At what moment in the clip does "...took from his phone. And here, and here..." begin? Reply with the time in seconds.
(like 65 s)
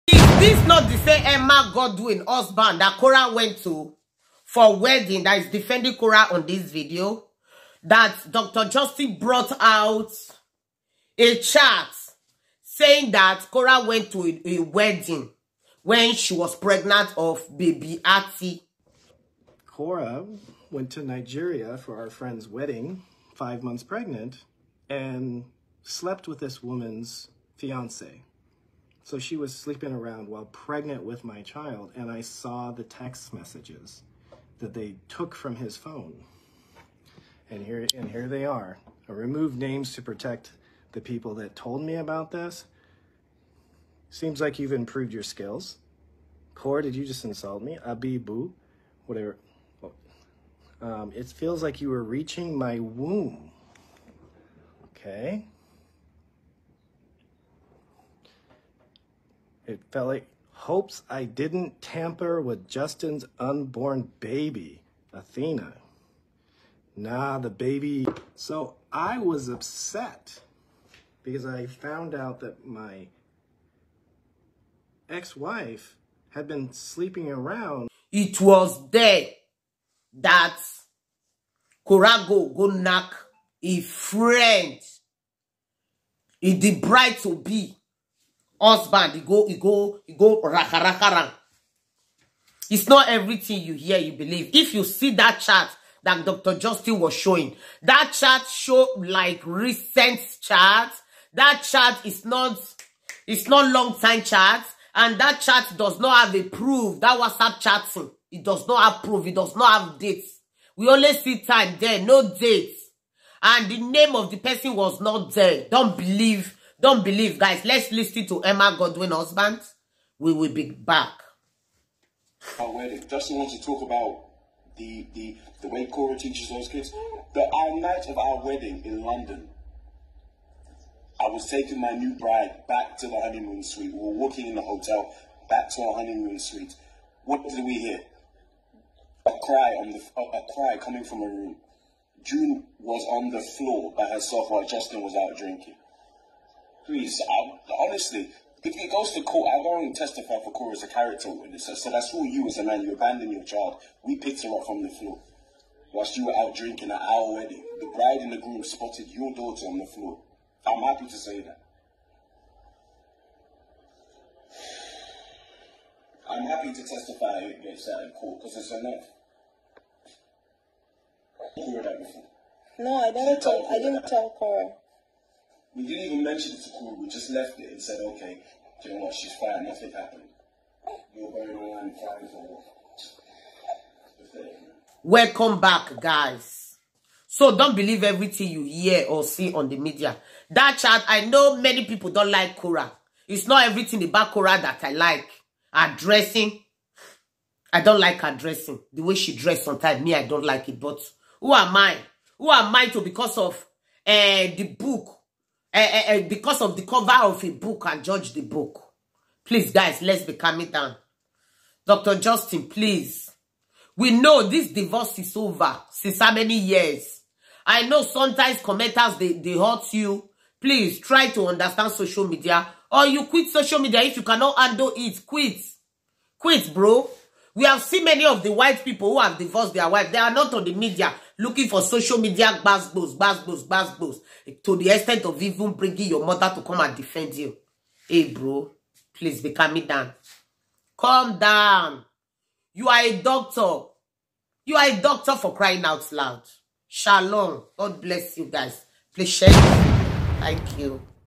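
35 s.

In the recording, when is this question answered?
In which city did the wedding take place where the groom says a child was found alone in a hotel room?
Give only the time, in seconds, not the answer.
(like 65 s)
129 s.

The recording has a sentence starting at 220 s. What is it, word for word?
Please, try to understand social media.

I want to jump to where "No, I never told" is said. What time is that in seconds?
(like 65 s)
172 s.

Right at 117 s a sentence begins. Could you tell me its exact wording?
Let's listen to Emma Godwin husband.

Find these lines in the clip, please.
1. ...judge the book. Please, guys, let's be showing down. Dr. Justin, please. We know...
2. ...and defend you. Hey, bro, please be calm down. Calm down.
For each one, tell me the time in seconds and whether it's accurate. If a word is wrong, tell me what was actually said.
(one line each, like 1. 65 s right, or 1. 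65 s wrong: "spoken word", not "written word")
1. 208 s wrong: "calming", not "showing"
2. 236 s right.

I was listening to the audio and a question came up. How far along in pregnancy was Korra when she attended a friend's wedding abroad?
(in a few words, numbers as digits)
5 months.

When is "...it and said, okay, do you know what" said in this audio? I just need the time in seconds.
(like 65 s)
177 s.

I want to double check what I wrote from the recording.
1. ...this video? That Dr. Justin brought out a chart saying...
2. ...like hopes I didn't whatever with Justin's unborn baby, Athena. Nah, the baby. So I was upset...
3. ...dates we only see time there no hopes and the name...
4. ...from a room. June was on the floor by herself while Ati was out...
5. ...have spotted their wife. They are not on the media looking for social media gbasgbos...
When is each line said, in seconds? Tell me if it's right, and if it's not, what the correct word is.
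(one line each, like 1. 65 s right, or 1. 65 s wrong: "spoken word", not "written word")
1. 6 s right
2. 60 s wrong: "tamper", not "whatever"
3. 109 s wrong: "dates", not "hopes"
4. 141 s wrong: "Justin", not "Ati"
5. 229 s wrong: "divorced", not "spotted".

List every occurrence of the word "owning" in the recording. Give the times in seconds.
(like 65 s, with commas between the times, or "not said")
not said.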